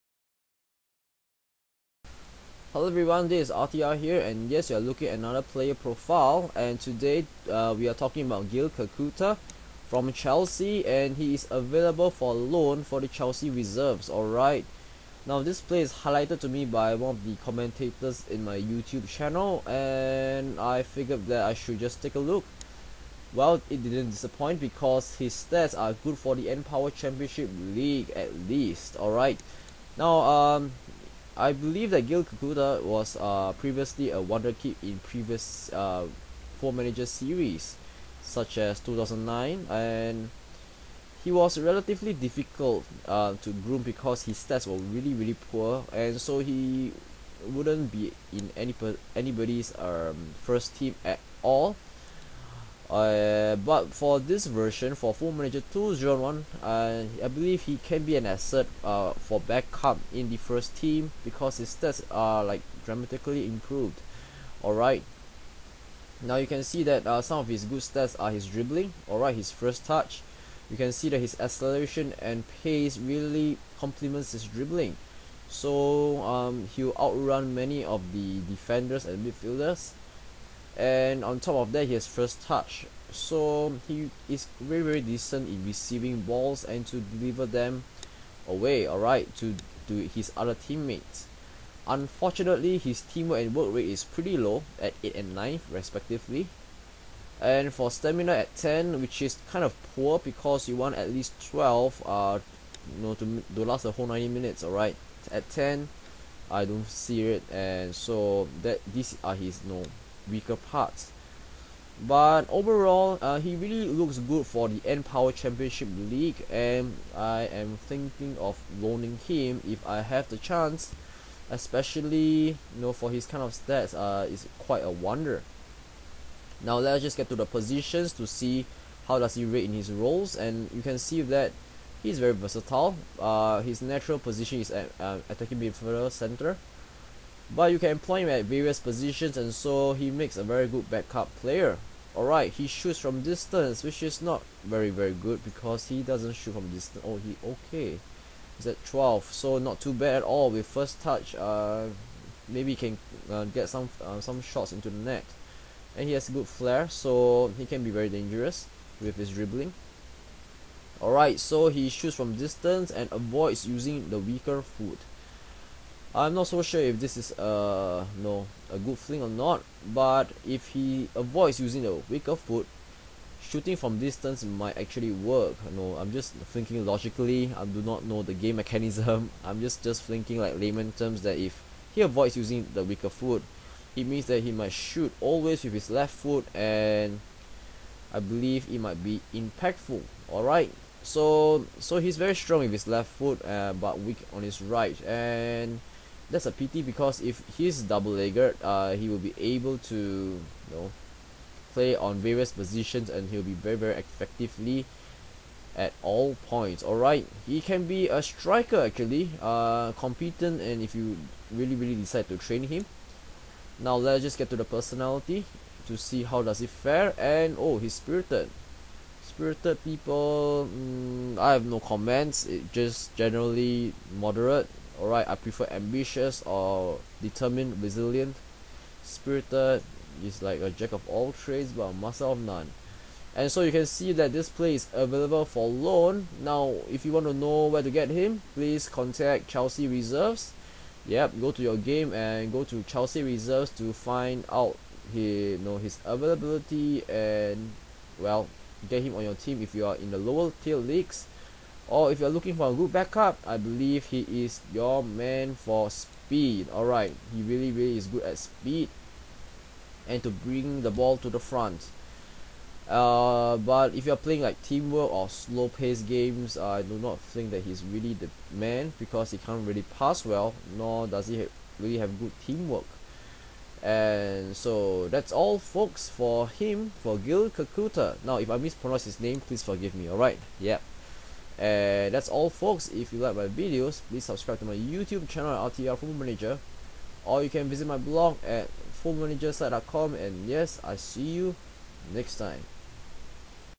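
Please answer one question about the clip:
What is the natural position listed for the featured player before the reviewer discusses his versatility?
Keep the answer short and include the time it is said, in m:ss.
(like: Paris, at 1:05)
attacking midfielder, center, at 2:15.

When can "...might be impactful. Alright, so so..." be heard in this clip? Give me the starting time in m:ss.
3:08.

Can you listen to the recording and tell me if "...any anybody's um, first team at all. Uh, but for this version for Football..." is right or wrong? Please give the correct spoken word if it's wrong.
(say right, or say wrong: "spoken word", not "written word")
right.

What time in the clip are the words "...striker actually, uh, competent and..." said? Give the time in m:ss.
3:28.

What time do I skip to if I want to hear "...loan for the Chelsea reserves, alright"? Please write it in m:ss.
0:12.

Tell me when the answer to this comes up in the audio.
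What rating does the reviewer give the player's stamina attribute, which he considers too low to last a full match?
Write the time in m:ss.
1:37.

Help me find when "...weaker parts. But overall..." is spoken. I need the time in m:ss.
1:50.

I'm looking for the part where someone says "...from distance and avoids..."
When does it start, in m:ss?
2:42.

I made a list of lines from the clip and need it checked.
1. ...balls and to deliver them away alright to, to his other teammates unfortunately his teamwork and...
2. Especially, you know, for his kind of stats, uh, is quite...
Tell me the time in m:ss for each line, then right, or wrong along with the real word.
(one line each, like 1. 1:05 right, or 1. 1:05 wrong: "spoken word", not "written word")
1. 1:26 right
2. 2:01 right.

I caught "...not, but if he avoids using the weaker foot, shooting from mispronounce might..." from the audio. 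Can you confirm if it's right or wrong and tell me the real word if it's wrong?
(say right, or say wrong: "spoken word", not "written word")
wrong: "distance", not "mispronounce".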